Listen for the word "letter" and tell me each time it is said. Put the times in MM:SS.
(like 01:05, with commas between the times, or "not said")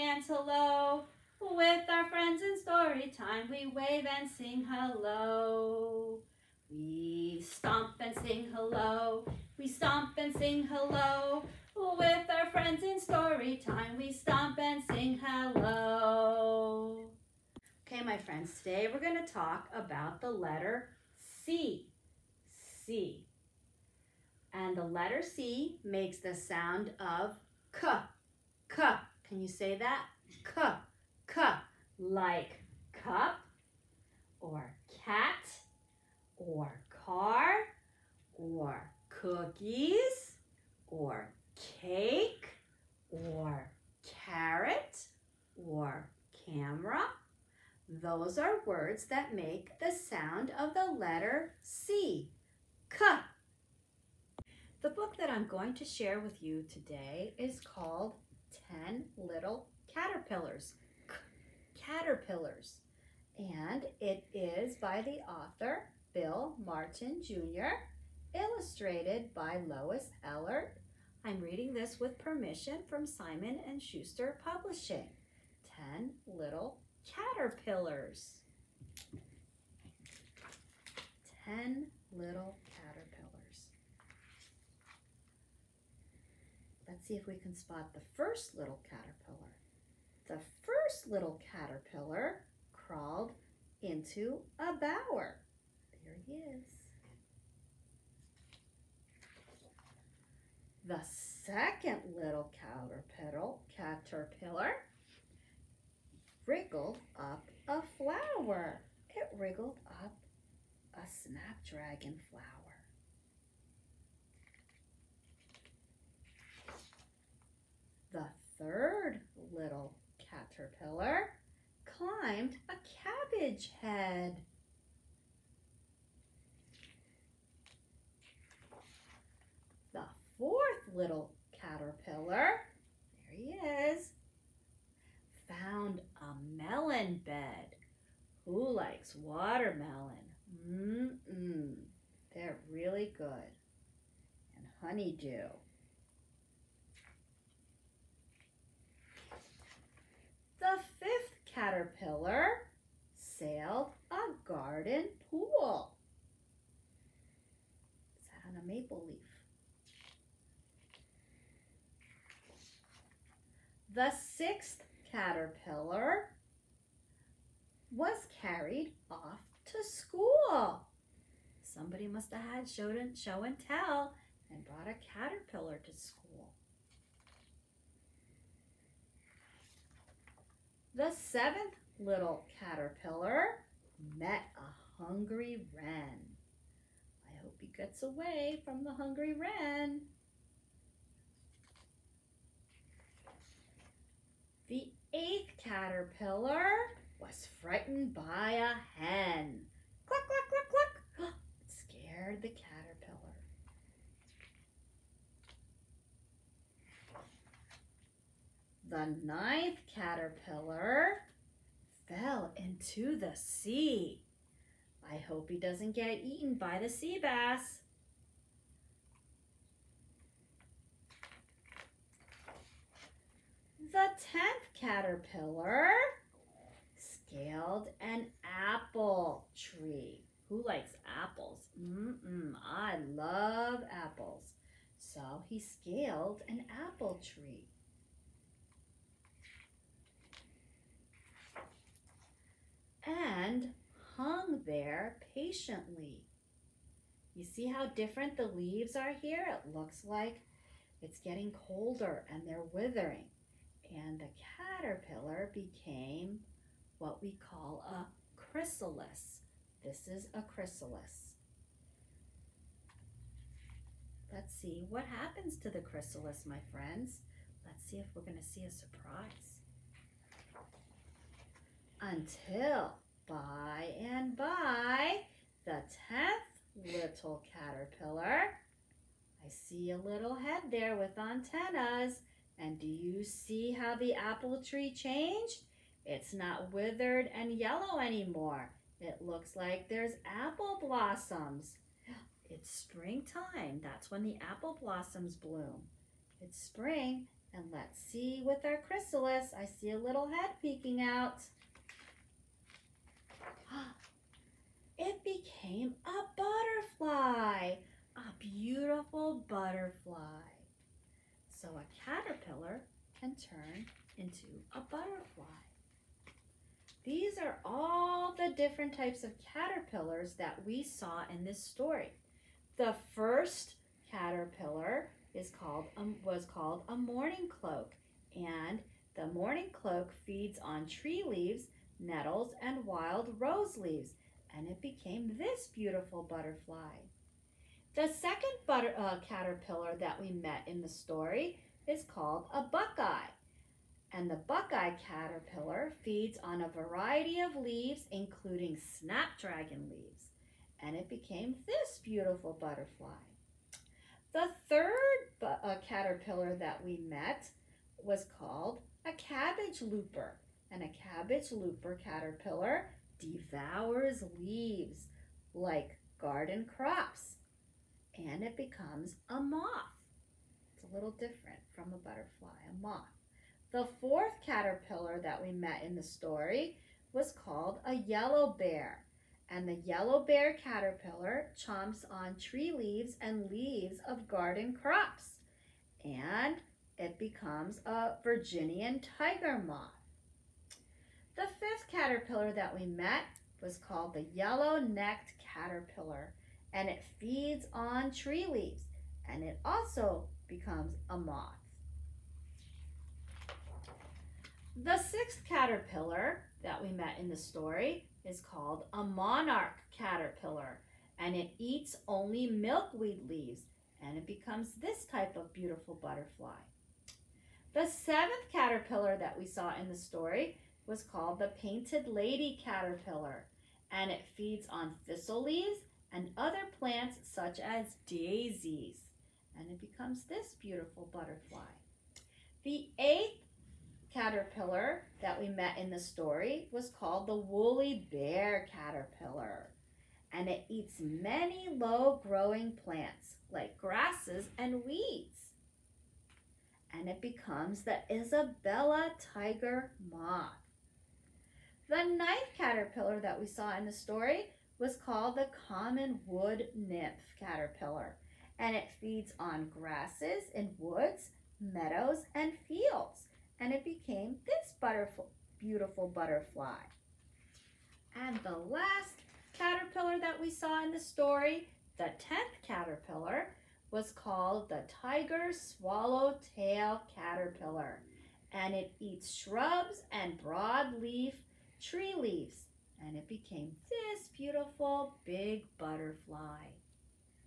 00:20, 00:24, 00:50.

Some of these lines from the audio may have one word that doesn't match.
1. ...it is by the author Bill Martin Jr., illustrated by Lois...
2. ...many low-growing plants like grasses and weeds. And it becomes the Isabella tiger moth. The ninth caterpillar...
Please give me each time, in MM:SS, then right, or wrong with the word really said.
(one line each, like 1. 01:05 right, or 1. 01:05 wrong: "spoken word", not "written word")
1. 01:04 right
2. 07:20 right.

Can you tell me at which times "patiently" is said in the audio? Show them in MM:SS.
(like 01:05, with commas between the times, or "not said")
04:05.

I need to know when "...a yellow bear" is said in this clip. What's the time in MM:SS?
06:17.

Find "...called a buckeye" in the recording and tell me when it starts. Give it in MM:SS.
05:42.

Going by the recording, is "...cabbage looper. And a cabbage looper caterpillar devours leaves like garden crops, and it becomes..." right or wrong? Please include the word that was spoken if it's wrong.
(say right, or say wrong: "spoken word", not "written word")
right.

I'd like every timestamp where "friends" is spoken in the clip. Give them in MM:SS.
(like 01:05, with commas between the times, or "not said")
00:02, 00:12, 00:18, 04:26.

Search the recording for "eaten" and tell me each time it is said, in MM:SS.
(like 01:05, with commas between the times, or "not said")
03:36.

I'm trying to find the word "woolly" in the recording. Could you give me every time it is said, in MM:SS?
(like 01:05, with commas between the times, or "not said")
07:17.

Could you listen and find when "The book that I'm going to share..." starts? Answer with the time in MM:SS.
00:54.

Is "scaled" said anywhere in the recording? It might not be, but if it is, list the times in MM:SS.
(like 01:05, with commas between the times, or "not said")
03:46, 03:55.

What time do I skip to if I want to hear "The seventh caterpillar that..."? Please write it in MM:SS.
06:57.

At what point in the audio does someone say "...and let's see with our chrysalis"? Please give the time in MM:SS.
04:57.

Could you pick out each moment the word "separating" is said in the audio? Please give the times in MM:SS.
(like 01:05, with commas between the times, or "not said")
not said.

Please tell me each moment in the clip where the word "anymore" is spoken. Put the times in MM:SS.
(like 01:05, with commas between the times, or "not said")
04:47.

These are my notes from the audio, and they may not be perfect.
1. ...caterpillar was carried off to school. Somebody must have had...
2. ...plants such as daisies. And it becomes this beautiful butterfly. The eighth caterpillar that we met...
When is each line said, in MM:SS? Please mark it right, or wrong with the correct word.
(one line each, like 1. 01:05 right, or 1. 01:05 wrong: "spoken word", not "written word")
1. 02:45 right
2. 07:06 right.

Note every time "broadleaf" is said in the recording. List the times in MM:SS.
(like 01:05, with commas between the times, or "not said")
08:00.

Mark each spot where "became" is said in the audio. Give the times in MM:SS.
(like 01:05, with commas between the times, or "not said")
04:15, 05:05, 05:34, 05:51, 07:43, 08:03.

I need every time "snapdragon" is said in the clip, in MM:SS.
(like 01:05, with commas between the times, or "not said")
01:51, 05:48.